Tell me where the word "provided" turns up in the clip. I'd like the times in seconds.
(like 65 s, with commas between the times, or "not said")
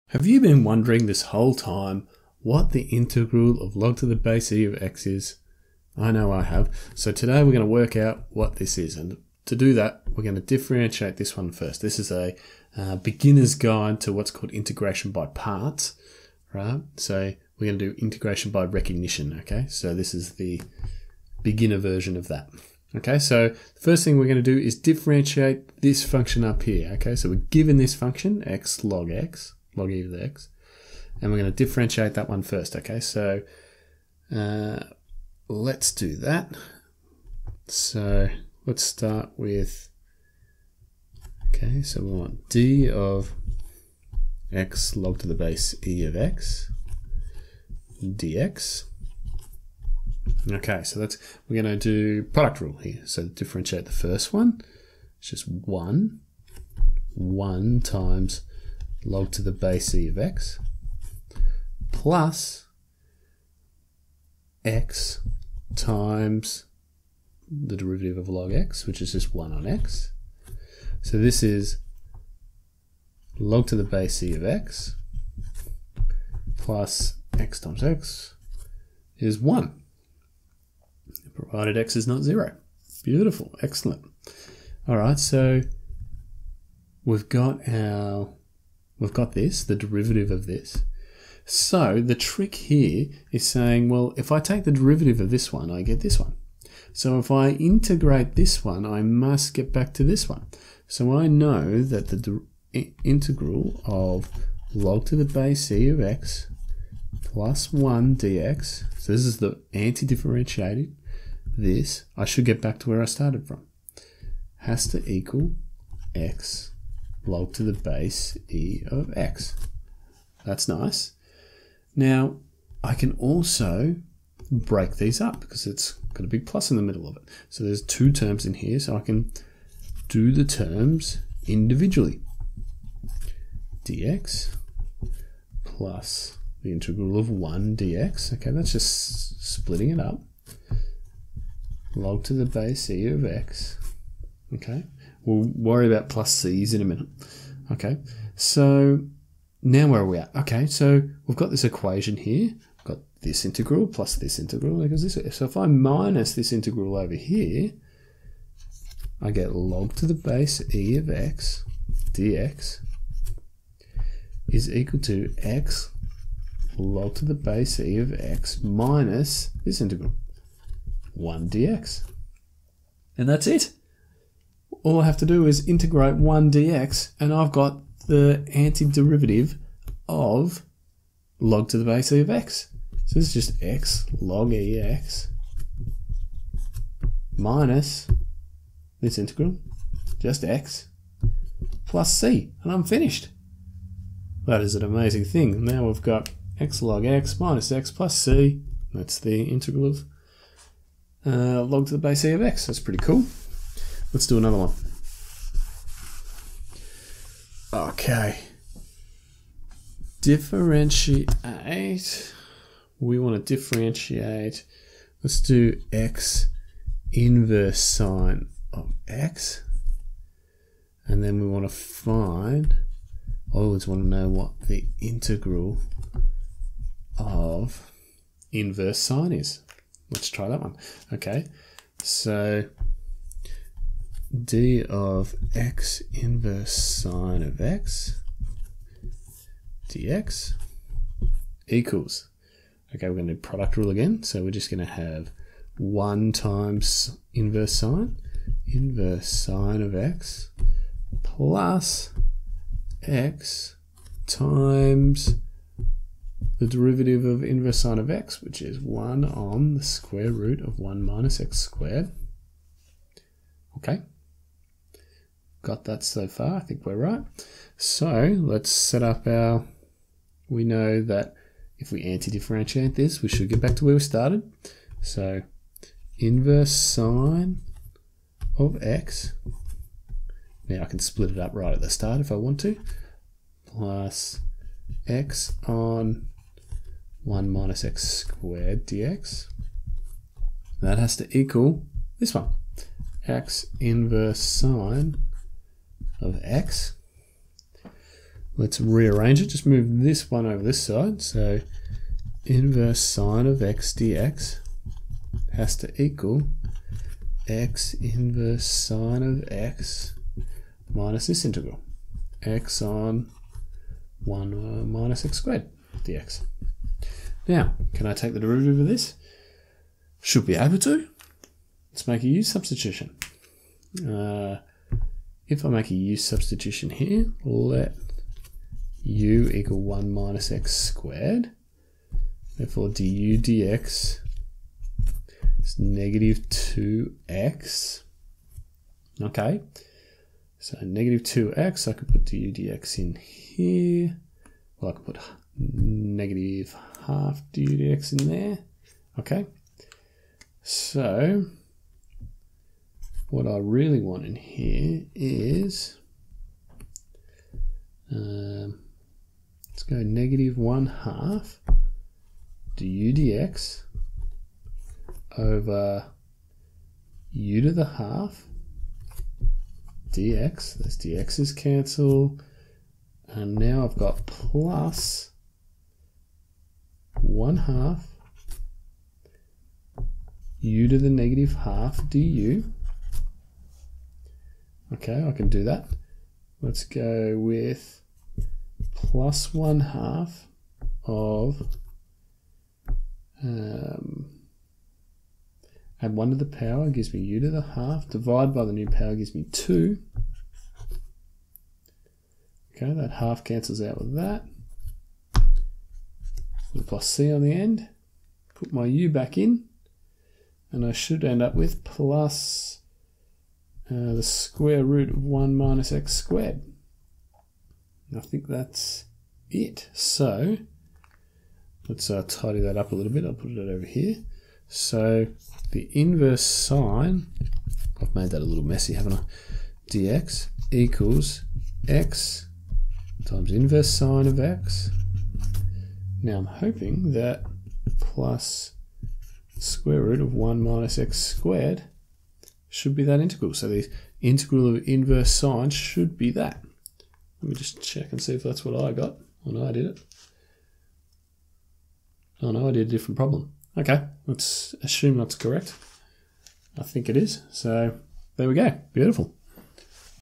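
81 s.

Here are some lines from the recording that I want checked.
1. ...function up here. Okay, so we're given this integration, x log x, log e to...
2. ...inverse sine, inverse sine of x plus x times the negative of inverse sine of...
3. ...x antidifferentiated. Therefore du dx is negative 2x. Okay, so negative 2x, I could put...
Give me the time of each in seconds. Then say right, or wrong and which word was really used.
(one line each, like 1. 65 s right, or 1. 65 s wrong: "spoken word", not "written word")
1. 26 s wrong: "function", not "integration"
2. 247 s wrong: "derivative", not "negative"
3. 330 s wrong: "squared", not "antidifferentiated".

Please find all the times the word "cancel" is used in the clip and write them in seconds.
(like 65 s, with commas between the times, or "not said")
371 s, 403 s.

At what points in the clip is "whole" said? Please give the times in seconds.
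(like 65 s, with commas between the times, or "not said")
1 s.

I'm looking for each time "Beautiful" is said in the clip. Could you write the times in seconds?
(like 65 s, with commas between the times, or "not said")
83 s, 458 s.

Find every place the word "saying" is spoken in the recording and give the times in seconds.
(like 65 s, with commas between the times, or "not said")
93 s.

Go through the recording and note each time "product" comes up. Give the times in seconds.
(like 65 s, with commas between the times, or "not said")
52 s, 243 s.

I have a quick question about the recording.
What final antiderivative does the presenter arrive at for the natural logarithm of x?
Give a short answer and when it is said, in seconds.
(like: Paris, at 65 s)
x log x minus x plus c, at 196 s.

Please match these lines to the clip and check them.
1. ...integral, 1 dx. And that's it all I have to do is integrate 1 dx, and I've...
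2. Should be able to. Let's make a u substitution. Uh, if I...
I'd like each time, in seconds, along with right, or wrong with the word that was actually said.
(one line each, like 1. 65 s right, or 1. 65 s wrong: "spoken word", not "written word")
1. 169 s right
2. 320 s right.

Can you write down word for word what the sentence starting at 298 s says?
Let's rearrange it, just move this one over this side.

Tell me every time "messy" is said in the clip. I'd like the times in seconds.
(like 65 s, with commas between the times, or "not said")
428 s.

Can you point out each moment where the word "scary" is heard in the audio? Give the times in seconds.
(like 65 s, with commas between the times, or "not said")
not said.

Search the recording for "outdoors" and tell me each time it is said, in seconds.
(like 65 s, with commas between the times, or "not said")
not said.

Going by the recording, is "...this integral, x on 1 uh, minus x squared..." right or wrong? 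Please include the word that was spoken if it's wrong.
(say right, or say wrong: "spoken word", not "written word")
right.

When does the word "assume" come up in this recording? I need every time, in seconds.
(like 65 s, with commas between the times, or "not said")
454 s.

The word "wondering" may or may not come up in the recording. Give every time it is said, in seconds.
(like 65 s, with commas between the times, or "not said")
0 s.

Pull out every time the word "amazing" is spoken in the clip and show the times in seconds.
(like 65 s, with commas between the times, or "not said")
194 s.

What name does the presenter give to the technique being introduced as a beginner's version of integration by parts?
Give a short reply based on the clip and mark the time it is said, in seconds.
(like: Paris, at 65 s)
integration by recognition, at 18 s.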